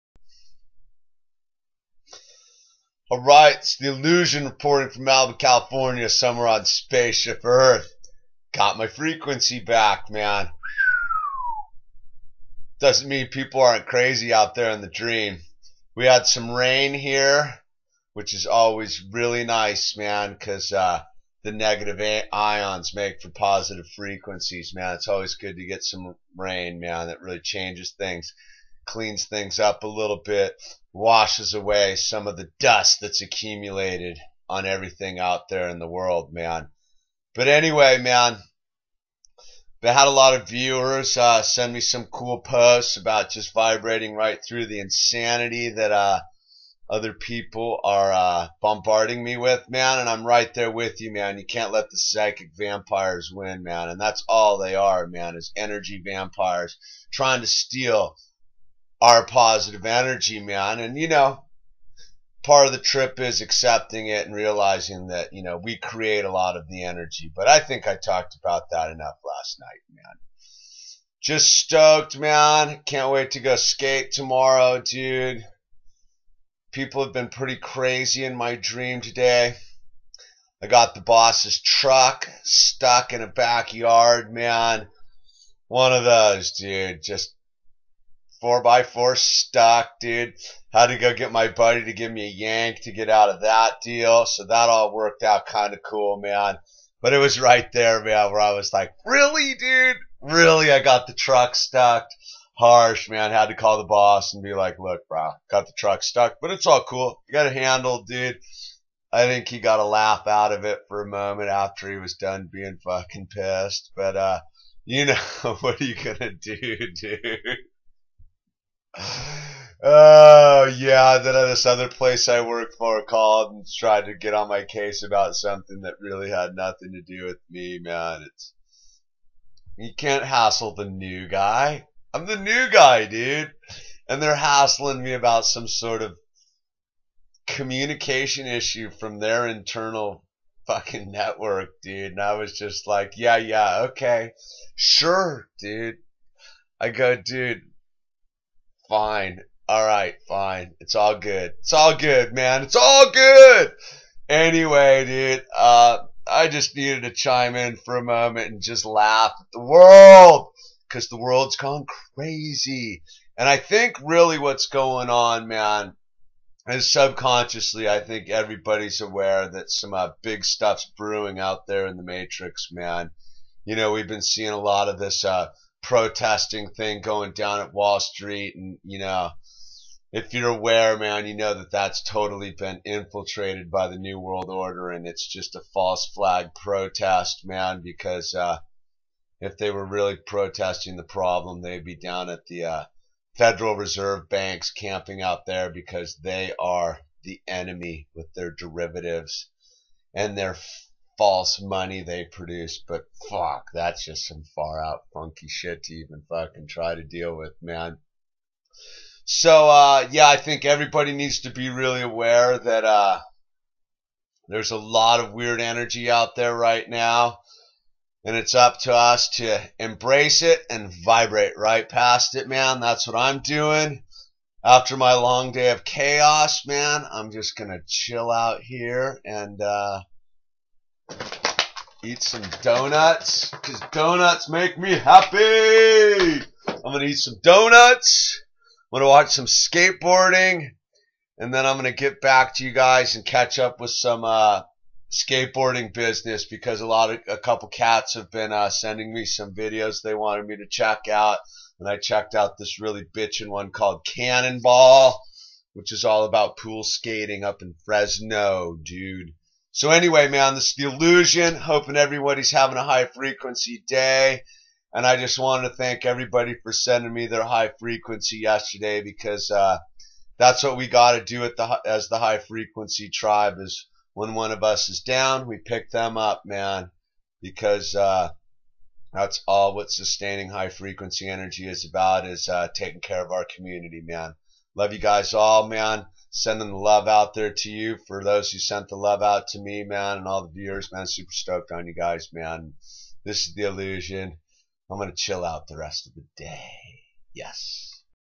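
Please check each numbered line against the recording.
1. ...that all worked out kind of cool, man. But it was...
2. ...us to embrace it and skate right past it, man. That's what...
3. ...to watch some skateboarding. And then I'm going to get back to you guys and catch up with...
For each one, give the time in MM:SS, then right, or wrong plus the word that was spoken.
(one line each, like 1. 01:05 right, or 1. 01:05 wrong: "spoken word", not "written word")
1. 01:34 right
2. 03:38 wrong: "vibrate", not "skate"
3. 03:59 right.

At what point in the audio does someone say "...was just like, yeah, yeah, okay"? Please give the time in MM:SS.
02:22.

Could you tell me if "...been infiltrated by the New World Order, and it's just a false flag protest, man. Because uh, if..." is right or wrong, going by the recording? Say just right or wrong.
right.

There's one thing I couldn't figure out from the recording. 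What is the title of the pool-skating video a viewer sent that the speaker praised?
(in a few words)
Cannonball.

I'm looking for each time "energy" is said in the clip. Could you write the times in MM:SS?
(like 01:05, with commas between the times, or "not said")
00:55, 00:59, 01:06, 03:35, 04:41.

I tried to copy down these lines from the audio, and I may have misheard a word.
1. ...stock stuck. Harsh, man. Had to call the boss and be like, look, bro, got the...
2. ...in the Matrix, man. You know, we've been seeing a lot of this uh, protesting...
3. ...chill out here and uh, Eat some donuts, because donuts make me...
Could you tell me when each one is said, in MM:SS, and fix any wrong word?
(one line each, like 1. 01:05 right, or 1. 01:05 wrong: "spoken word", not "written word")
1. 01:41 wrong: "truck", not "stock"
2. 02:51 right
3. 03:47 right.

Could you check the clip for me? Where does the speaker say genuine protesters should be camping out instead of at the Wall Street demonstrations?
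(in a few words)
Federal Reserve banks.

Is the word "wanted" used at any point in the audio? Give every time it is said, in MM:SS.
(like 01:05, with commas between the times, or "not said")
04:10, 04:25.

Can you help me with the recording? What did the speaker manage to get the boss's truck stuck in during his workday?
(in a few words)
A backyard.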